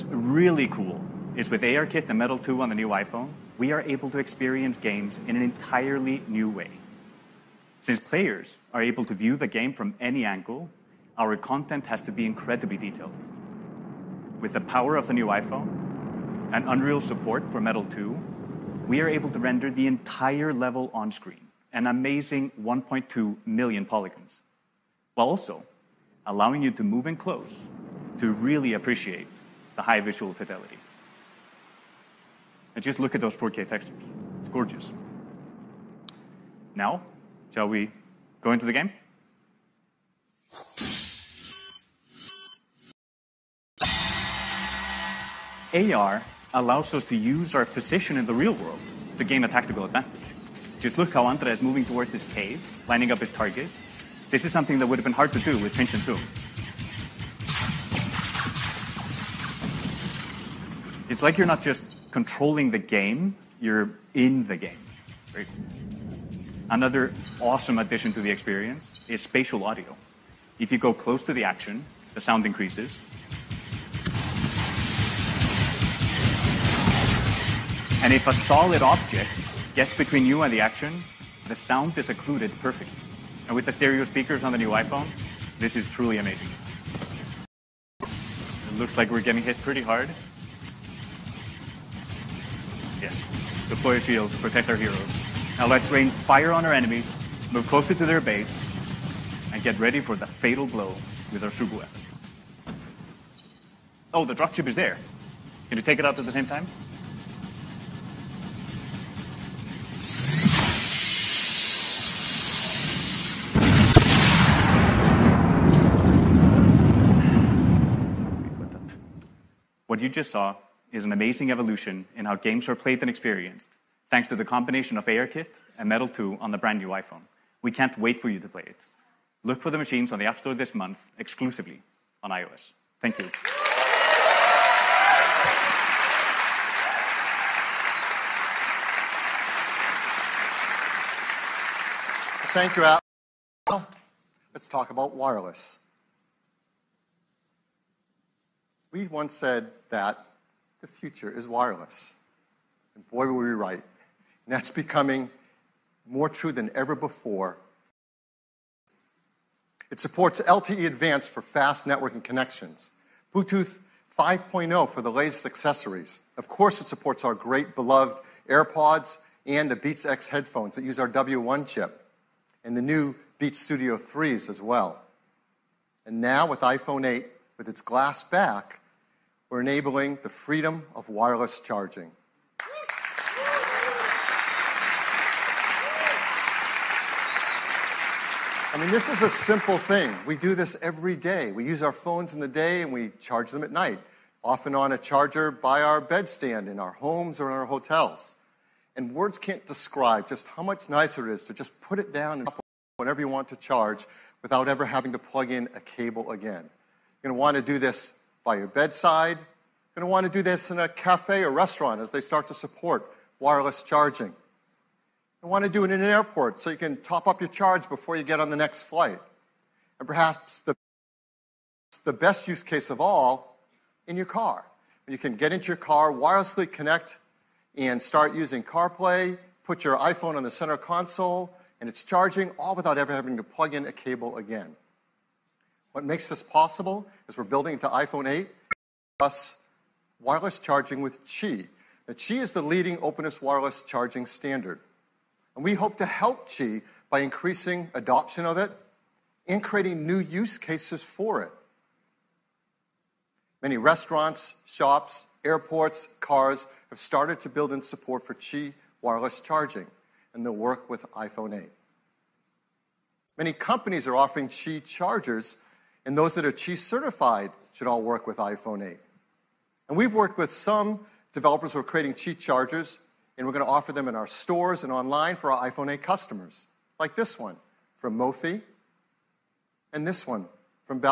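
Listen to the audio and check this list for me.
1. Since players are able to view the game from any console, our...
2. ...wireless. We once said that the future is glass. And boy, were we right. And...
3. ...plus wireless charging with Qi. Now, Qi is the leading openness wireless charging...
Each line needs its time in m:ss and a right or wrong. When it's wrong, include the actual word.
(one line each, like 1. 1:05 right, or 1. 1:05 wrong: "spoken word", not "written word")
1. 0:07 wrong: "angle", not "console"
2. 2:25 wrong: "wireless", not "glass"
3. 3:59 right.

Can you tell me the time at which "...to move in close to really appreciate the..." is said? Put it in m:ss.
0:26.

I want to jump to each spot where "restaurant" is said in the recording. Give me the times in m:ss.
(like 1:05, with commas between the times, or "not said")
3:31, 4:13.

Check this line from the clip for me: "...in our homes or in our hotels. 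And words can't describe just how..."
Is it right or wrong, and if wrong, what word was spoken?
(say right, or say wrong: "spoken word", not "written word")
right.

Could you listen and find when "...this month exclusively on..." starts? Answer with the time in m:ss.
2:10.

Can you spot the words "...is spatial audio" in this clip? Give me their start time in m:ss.
1:09.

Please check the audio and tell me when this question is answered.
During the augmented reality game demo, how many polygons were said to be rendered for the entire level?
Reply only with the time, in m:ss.
0:22.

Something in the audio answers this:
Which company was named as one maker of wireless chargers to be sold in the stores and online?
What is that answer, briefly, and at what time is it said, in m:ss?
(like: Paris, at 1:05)
Mophie, at 4:38.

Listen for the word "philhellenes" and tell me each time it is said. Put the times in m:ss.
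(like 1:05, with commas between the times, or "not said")
not said.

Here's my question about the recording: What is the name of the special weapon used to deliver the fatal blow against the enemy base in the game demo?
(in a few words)
Sugu.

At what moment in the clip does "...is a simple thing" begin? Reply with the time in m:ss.
3:09.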